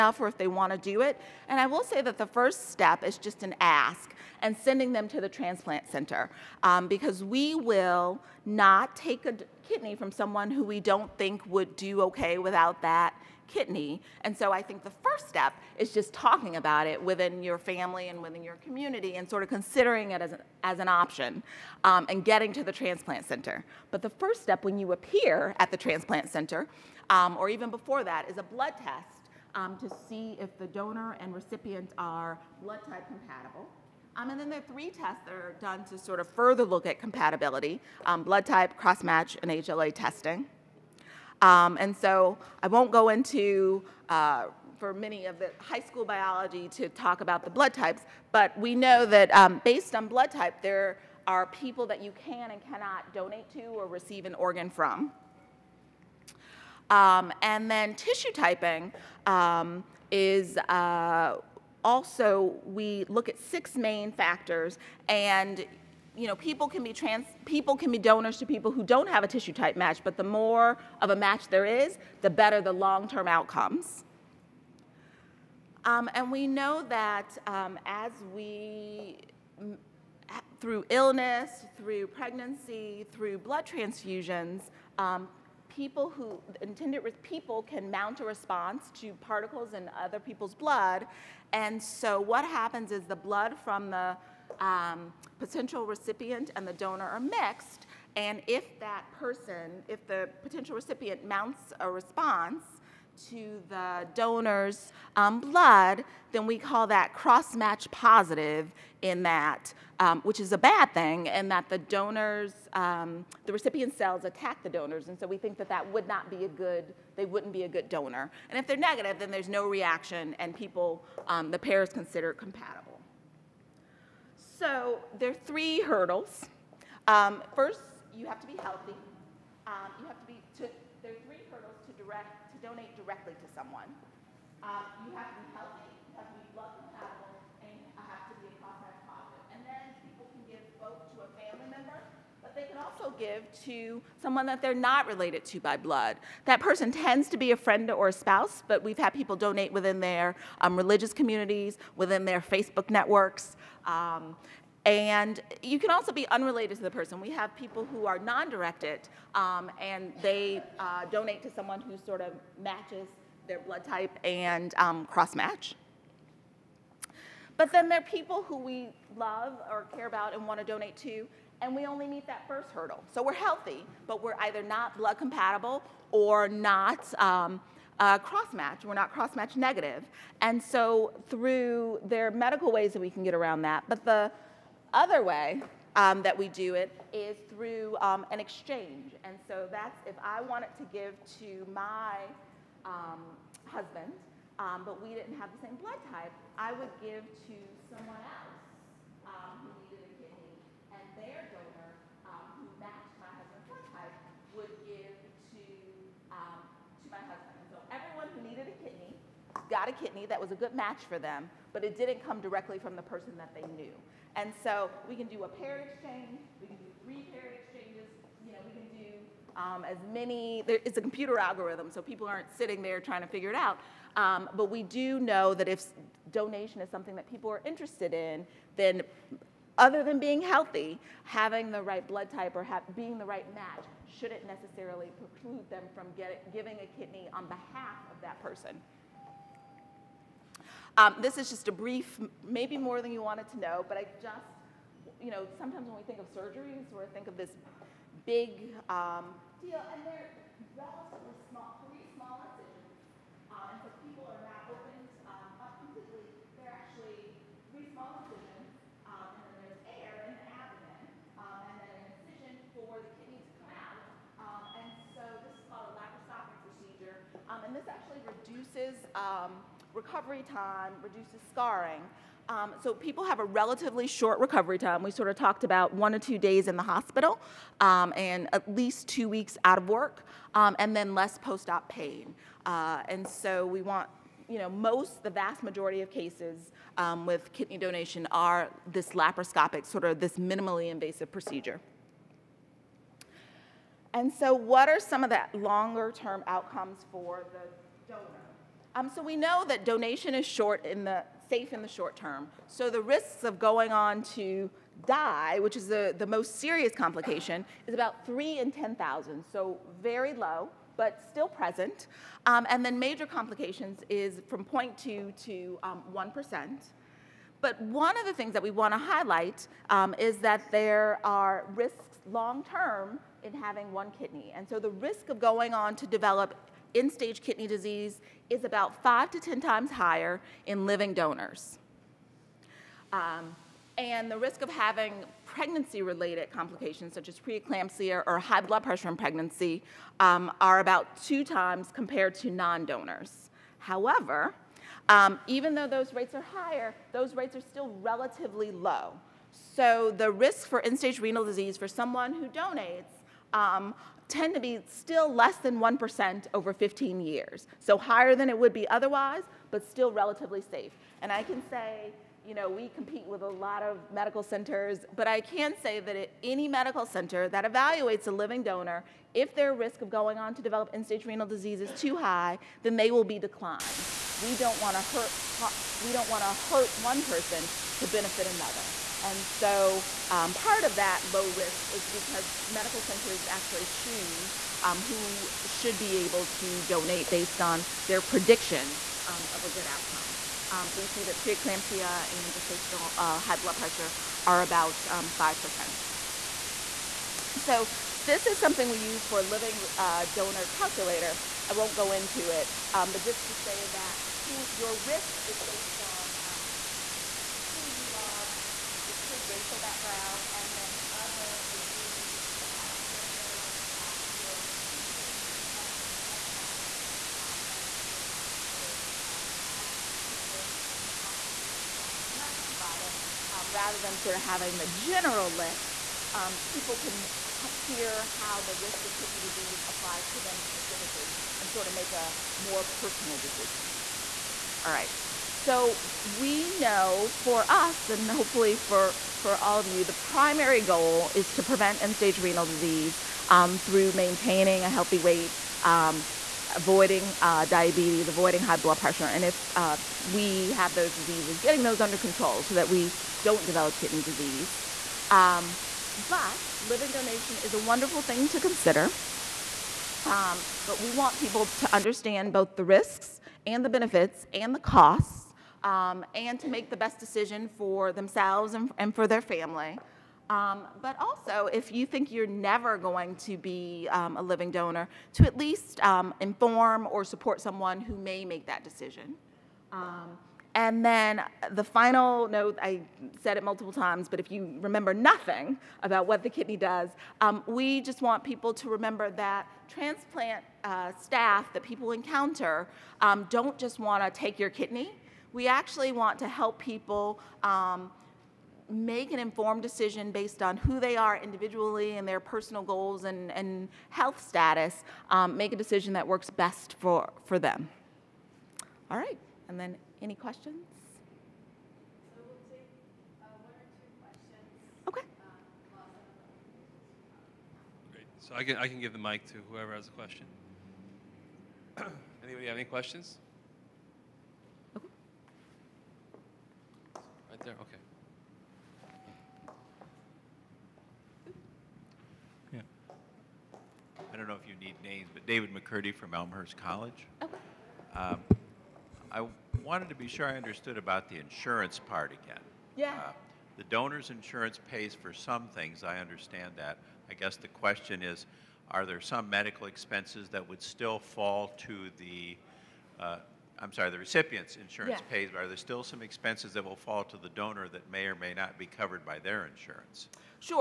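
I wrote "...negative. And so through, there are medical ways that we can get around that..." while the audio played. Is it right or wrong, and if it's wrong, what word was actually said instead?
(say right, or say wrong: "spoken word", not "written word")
right.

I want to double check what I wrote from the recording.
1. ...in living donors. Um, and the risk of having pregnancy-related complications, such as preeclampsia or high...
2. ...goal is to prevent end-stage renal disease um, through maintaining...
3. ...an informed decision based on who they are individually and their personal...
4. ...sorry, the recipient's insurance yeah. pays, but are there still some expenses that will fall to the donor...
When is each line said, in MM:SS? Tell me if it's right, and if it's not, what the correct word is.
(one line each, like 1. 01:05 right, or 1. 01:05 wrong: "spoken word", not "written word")
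1. 05:30 right
2. 07:20 right
3. 08:19 right
4. 09:13 right.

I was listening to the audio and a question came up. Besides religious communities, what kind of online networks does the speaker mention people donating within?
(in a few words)
Facebook networks.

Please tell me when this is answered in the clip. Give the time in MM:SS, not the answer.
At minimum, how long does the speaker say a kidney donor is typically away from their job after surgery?
04:39.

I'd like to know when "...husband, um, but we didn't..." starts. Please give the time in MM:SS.
03:13.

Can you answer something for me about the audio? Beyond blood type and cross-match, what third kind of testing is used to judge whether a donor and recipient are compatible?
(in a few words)
HLA testing.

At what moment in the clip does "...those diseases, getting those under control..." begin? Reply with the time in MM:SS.
07:30.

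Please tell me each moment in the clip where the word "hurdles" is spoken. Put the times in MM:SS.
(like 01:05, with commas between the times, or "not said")
02:05, 02:11, 02:52.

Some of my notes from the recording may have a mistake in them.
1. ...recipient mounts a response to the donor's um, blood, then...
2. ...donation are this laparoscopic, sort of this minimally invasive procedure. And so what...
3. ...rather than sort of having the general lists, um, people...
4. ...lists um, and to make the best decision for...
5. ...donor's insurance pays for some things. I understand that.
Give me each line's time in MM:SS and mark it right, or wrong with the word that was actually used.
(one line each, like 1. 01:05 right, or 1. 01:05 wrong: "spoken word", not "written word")
1. 01:40 right
2. 04:47 right
3. 07:03 right
4. 07:44 wrong: "costs", not "lists"
5. 09:03 right.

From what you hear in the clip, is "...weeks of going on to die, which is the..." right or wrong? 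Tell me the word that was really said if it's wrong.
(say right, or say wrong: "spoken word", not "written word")
wrong: "risks", not "weeks".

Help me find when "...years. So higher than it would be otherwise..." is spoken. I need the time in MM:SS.
05:57.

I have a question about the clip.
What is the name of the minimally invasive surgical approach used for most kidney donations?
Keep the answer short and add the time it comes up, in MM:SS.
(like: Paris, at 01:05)
laparoscopic procedure, at 04:25.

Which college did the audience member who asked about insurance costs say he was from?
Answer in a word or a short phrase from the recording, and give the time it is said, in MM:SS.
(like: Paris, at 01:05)
Elmhurst College, at 08:56.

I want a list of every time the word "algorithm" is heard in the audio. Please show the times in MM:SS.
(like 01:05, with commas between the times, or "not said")
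03:41.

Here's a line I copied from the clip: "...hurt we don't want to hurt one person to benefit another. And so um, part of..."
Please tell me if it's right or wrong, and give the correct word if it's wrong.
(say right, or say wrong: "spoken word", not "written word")
right.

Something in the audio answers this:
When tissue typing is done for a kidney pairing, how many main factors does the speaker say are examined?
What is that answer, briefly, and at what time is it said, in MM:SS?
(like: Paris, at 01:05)
6, at 01:03.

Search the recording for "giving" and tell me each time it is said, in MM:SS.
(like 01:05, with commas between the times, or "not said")
03:56.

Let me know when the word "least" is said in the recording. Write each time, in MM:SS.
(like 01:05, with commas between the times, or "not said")
04:38, 07:55.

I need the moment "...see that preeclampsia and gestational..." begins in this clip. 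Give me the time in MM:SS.
06:31.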